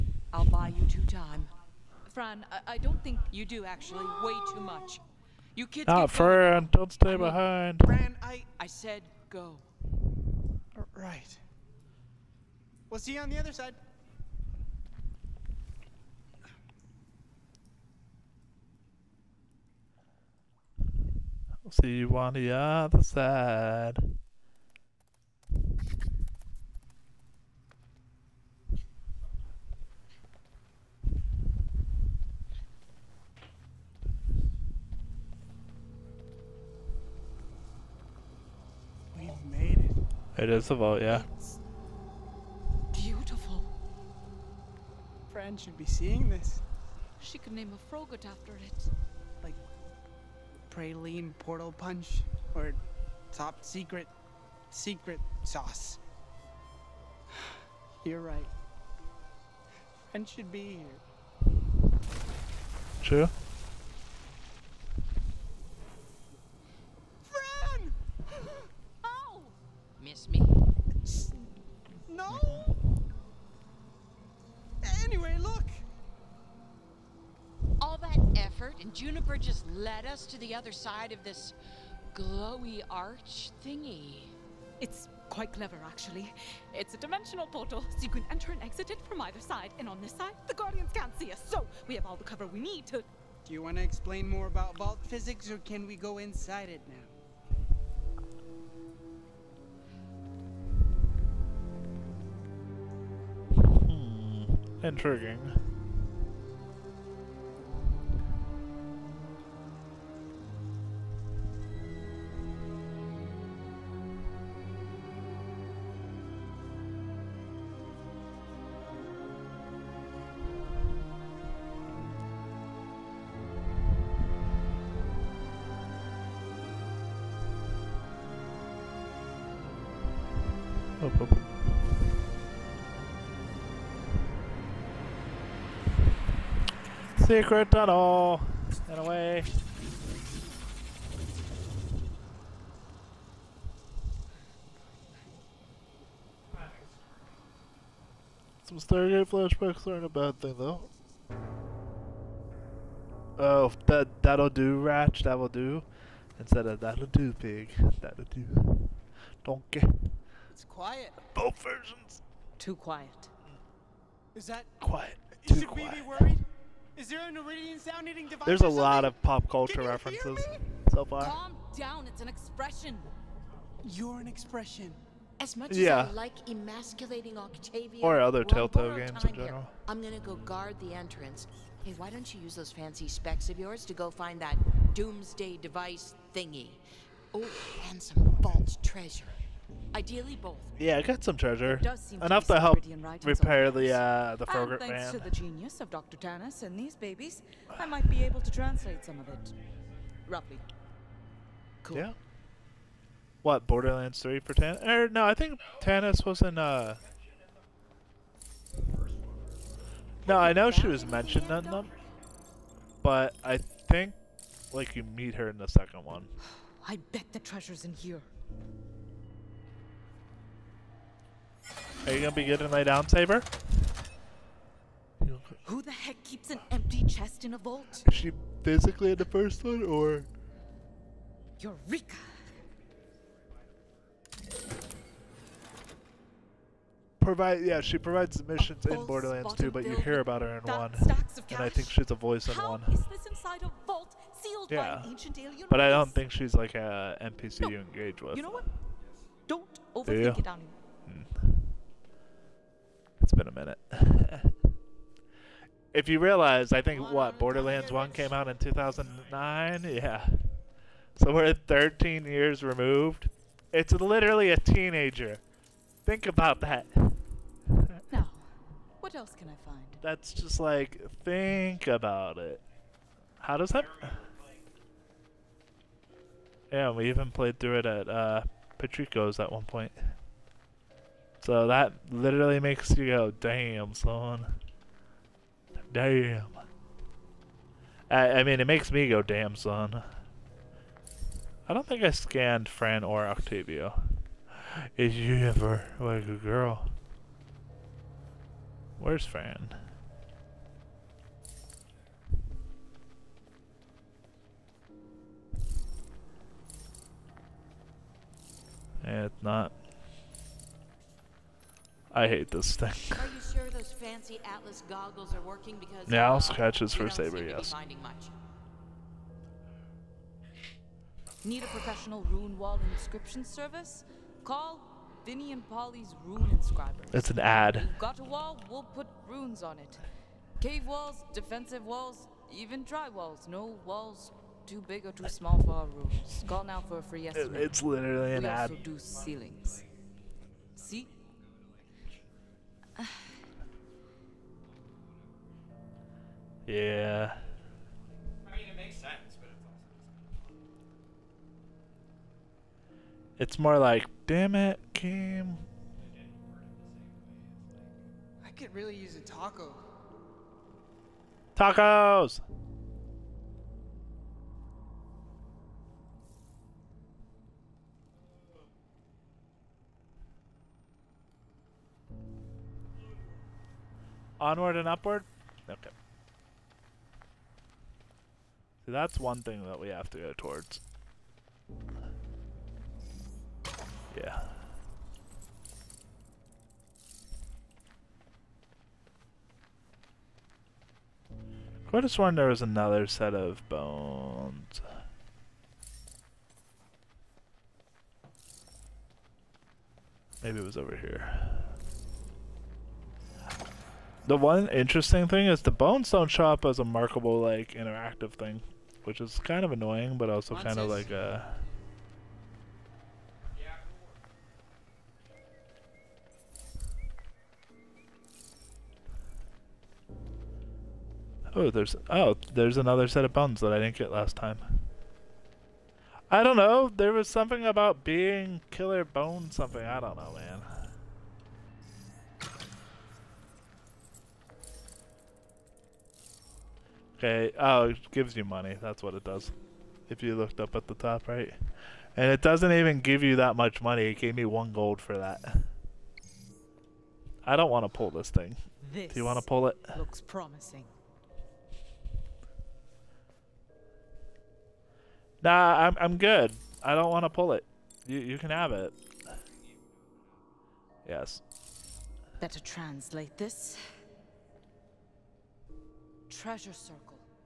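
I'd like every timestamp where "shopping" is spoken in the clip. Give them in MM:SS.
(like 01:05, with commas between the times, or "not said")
not said.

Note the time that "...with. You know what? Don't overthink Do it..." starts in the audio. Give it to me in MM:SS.
04:08.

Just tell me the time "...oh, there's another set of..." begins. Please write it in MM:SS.
07:02.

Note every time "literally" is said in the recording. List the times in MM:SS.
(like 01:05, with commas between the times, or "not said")
04:23, 04:42, 05:37.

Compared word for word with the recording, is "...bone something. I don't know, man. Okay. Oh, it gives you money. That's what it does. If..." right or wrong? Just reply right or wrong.
right.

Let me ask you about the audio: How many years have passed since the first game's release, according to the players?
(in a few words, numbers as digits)
13.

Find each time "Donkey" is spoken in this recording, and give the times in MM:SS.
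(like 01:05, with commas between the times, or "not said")
02:39.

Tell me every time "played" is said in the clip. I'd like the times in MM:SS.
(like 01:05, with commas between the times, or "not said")
04:37.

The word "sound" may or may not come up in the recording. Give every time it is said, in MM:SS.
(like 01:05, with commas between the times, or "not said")
02:47.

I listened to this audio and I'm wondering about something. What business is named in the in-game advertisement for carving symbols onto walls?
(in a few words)
Vinny and Polly's.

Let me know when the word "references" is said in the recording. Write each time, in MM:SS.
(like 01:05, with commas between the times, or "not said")
02:49.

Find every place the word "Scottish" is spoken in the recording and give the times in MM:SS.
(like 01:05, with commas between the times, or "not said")
not said.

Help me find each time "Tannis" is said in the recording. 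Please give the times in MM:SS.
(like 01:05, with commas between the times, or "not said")
03:16, 03:25.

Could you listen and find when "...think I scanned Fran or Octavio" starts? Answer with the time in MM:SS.
04:51.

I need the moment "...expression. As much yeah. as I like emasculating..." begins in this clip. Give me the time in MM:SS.
02:54.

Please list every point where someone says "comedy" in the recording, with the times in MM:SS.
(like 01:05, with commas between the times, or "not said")
not said.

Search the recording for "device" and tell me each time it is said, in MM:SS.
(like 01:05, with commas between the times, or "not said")
02:48, 03:05.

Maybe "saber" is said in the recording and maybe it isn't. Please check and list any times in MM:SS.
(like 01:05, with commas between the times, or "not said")
03:43, 05:17.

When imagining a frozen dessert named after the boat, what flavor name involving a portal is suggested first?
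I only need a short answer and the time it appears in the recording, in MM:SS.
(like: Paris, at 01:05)
praline portal punch, at 00:50.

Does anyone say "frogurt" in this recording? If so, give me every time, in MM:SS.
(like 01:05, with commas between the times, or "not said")
00:47, 03:14.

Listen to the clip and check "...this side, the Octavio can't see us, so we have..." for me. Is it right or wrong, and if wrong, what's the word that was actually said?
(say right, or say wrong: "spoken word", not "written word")
wrong: "Guardians", not "Octavio".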